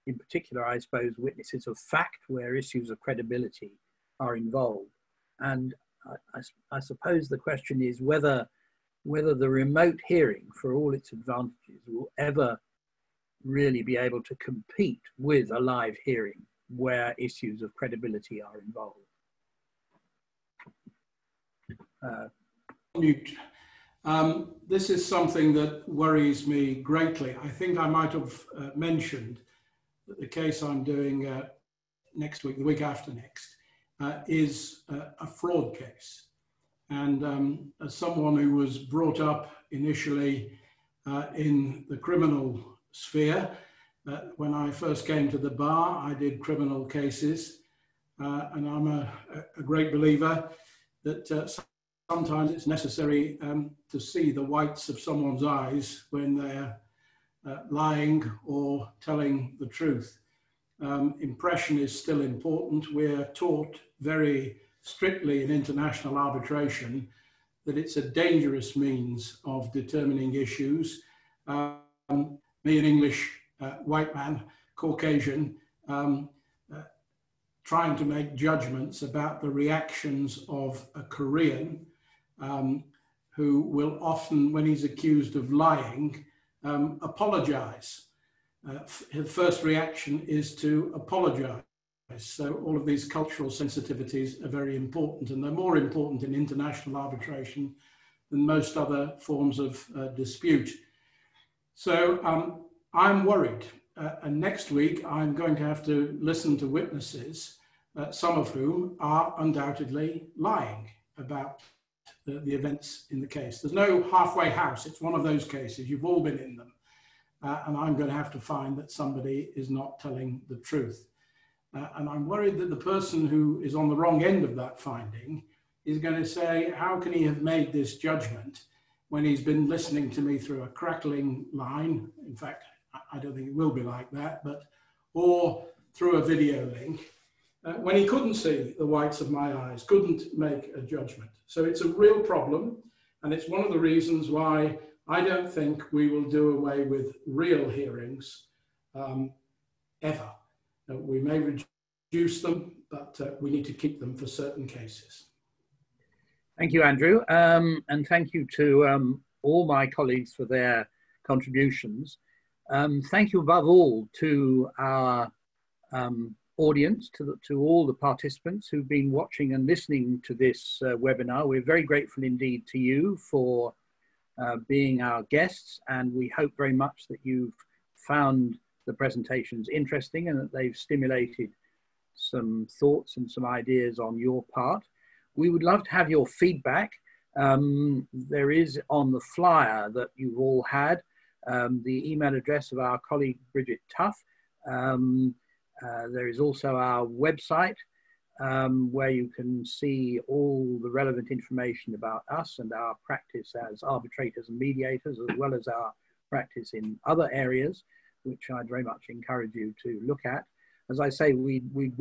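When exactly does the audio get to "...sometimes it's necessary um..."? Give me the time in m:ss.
0:52.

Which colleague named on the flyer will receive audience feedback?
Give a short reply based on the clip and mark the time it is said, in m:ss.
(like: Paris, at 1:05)
Bridget Tuff, at 3:13.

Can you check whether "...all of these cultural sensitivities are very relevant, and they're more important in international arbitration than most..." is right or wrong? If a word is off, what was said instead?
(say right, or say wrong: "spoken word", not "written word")
wrong: "important", not "relevant".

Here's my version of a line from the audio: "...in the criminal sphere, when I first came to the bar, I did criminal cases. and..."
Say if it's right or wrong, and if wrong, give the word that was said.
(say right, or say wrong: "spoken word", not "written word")
right.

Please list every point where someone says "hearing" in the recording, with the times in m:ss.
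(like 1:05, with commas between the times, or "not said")
0:10, 0:16, 2:27.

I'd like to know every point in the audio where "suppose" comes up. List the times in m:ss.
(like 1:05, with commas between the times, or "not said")
0:00, 0:06.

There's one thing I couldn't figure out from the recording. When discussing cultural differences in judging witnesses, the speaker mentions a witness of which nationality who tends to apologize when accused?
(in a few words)
Korean.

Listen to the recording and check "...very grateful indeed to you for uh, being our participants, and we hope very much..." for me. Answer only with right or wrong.
wrong.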